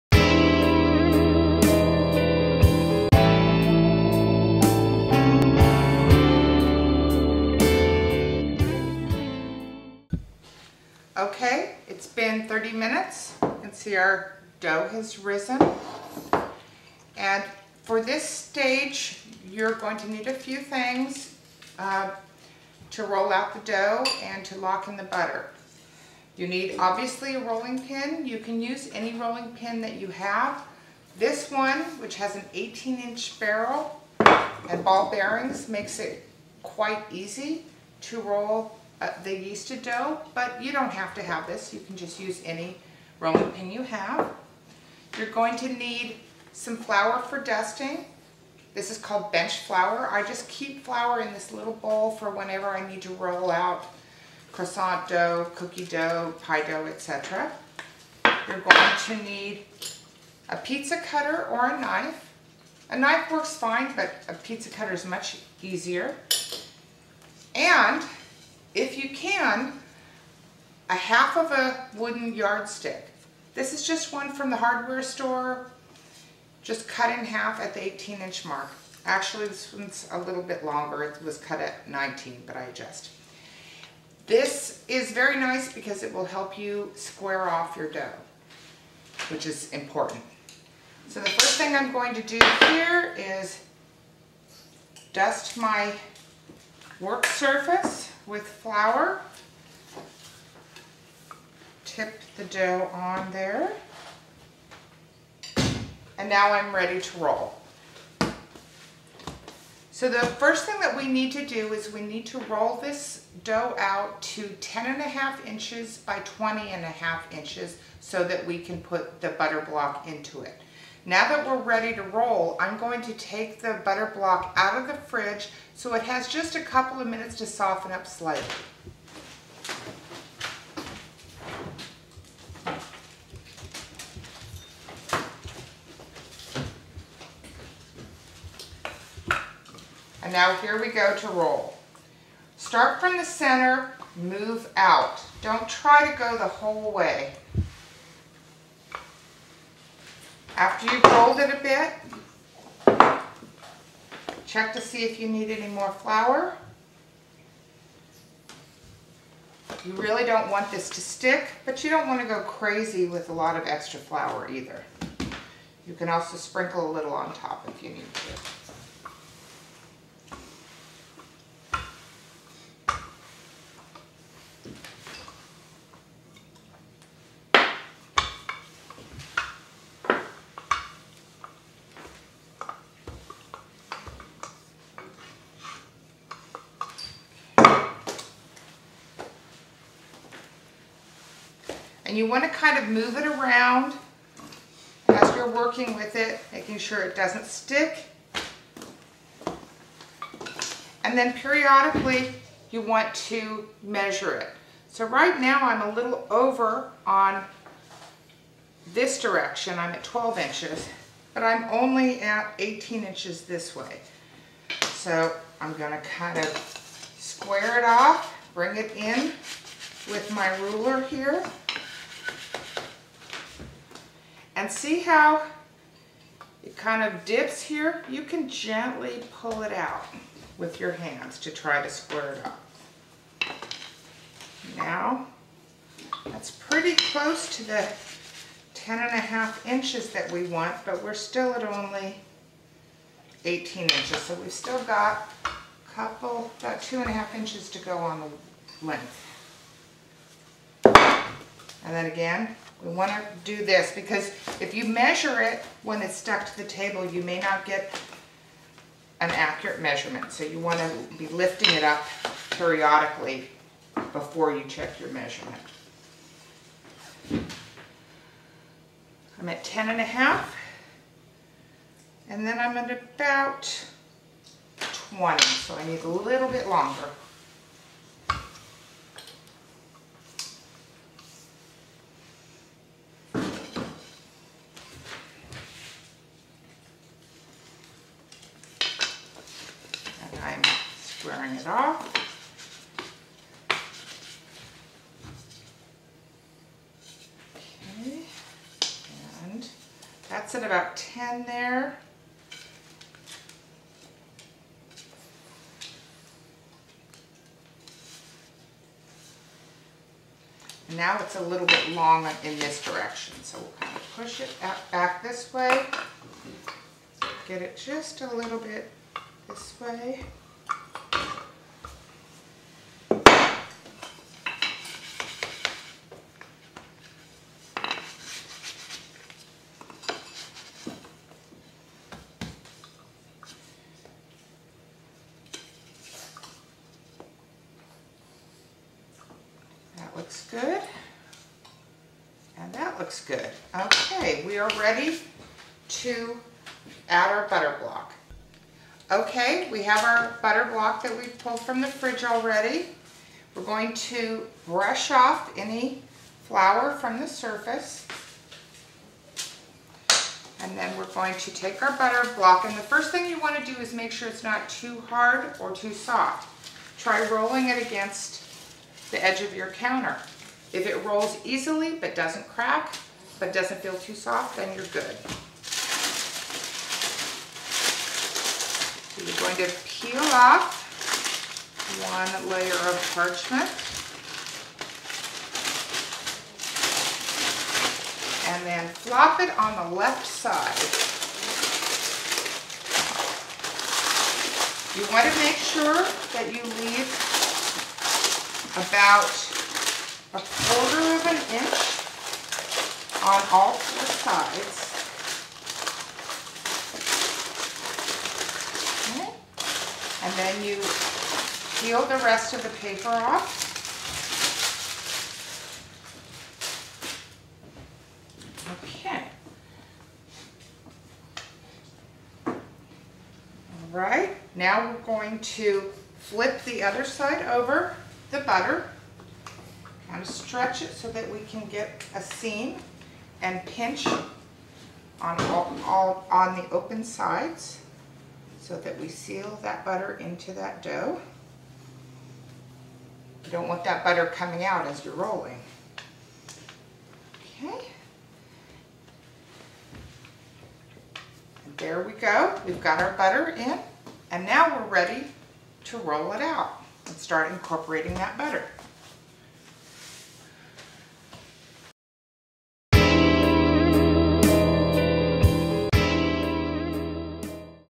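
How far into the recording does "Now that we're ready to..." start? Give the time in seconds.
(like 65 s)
121 s.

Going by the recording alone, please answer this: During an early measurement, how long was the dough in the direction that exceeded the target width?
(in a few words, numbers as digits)
12 inches.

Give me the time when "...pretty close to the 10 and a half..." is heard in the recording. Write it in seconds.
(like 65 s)
236 s.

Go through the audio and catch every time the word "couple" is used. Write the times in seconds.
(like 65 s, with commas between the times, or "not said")
126 s, 245 s.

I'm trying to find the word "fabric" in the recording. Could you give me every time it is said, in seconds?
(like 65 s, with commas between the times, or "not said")
not said.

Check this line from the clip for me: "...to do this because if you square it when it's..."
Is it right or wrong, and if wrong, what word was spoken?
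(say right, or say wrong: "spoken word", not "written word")
wrong: "measure", not "square".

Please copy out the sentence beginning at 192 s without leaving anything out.
And you want to kind of move it around as you're working with it, making sure it doesn't stick.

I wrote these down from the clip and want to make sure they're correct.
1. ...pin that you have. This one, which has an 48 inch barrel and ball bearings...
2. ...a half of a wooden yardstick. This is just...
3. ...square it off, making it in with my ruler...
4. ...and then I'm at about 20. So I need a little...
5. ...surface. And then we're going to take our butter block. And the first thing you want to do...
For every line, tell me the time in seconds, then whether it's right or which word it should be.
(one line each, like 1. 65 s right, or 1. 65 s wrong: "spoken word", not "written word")
1. 29 s wrong: "18", not "48"
2. 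70 s right
3. 217 s wrong: "bring", not "making"
4. 272 s right
5. 357 s right.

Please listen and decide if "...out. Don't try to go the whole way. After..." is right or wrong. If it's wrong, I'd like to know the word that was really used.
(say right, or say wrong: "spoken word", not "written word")
right.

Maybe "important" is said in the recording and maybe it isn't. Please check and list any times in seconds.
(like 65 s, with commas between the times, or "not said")
89 s.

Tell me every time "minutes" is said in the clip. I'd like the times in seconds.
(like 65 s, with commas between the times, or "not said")
12 s, 127 s.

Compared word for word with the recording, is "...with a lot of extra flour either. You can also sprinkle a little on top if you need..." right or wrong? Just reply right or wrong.
right.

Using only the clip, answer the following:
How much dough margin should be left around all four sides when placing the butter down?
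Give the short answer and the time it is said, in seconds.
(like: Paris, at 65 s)
a quarter of an inch, at 400 s.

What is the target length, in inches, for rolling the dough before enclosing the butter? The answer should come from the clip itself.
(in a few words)
20 and a half inches.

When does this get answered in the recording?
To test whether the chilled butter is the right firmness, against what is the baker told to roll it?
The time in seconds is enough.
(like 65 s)
369 s.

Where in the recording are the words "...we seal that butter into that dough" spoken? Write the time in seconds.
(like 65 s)
438 s.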